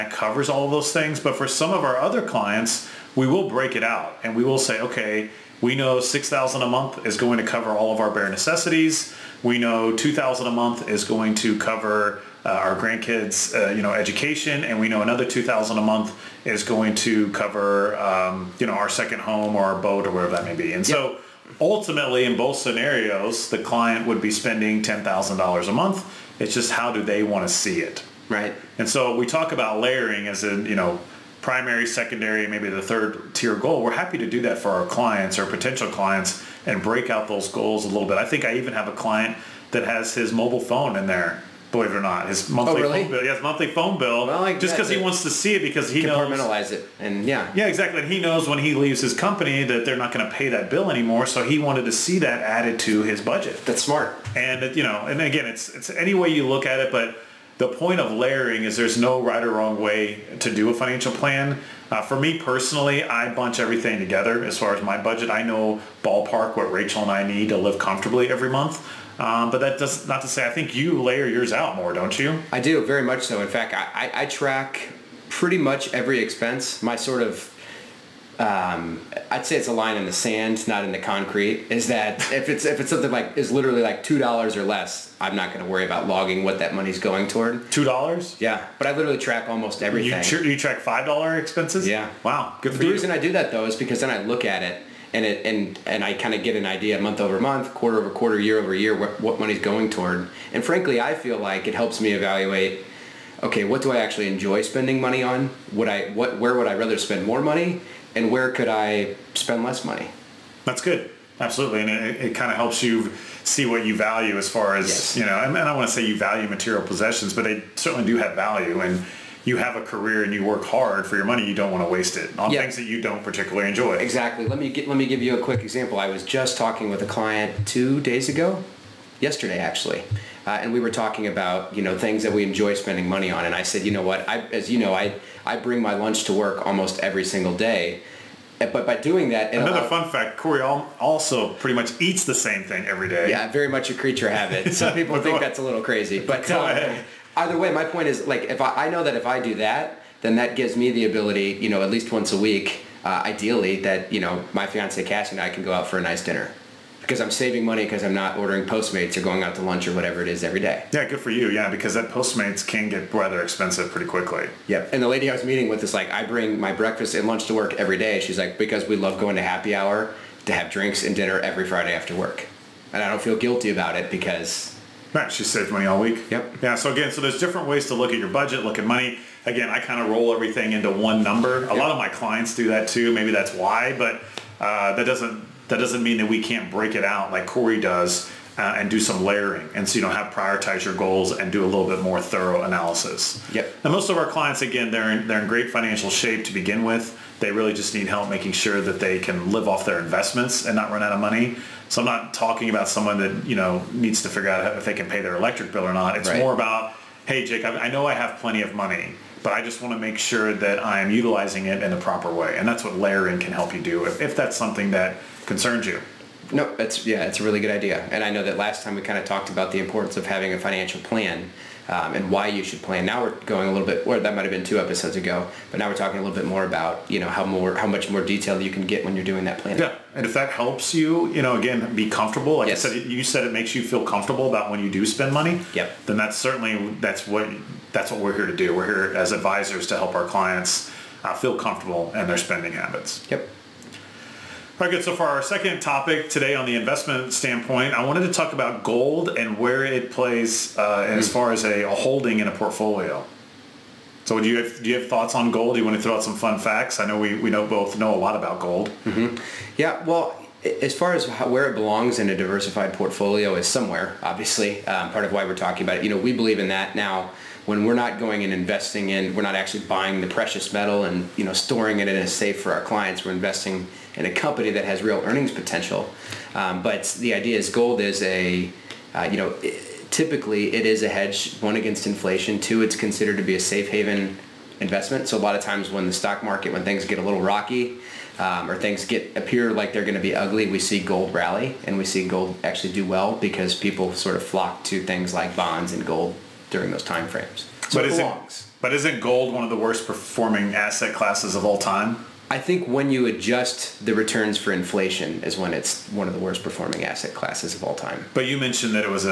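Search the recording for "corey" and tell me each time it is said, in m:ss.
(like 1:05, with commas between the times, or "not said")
2:20, 3:07.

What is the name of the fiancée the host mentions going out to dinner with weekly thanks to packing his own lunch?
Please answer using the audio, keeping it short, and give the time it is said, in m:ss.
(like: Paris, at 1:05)
Cassie, at 2:35.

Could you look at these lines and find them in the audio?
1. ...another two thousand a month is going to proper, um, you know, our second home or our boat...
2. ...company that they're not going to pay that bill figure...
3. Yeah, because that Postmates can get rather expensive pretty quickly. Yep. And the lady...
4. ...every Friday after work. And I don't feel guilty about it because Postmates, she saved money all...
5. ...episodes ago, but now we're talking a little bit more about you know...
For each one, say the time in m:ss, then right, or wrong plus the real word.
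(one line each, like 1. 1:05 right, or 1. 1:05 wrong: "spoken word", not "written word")
1. 0:15 wrong: "cover", not "proper"
2. 0:49 wrong: "anymore", not "figure"
3. 2:41 right
4. 2:51 wrong: "Matt", not "Postmates"
5. 3:44 right.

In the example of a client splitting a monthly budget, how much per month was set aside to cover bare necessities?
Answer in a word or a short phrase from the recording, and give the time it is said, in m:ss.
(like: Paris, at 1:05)
$6,000, at 0:05.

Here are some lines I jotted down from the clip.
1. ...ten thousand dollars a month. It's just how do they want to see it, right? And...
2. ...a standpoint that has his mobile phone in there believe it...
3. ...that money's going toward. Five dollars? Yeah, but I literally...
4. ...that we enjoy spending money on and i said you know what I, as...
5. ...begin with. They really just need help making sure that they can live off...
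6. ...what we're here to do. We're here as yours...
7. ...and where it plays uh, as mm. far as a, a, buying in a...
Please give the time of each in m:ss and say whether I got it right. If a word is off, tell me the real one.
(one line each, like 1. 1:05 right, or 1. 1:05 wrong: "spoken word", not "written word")
1. 0:24 right
2. 0:38 wrong: "client", not "standpoint"
3. 1:26 wrong: "Two", not "Five"
4. 2:12 right
5. 3:16 right
6. 3:58 wrong: "advisors", not "yours"
7. 4:09 wrong: "holding", not "buying".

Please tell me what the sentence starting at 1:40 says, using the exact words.
And frankly, I feel like it helps me evaluate.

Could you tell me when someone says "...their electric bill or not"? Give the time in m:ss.
3:25.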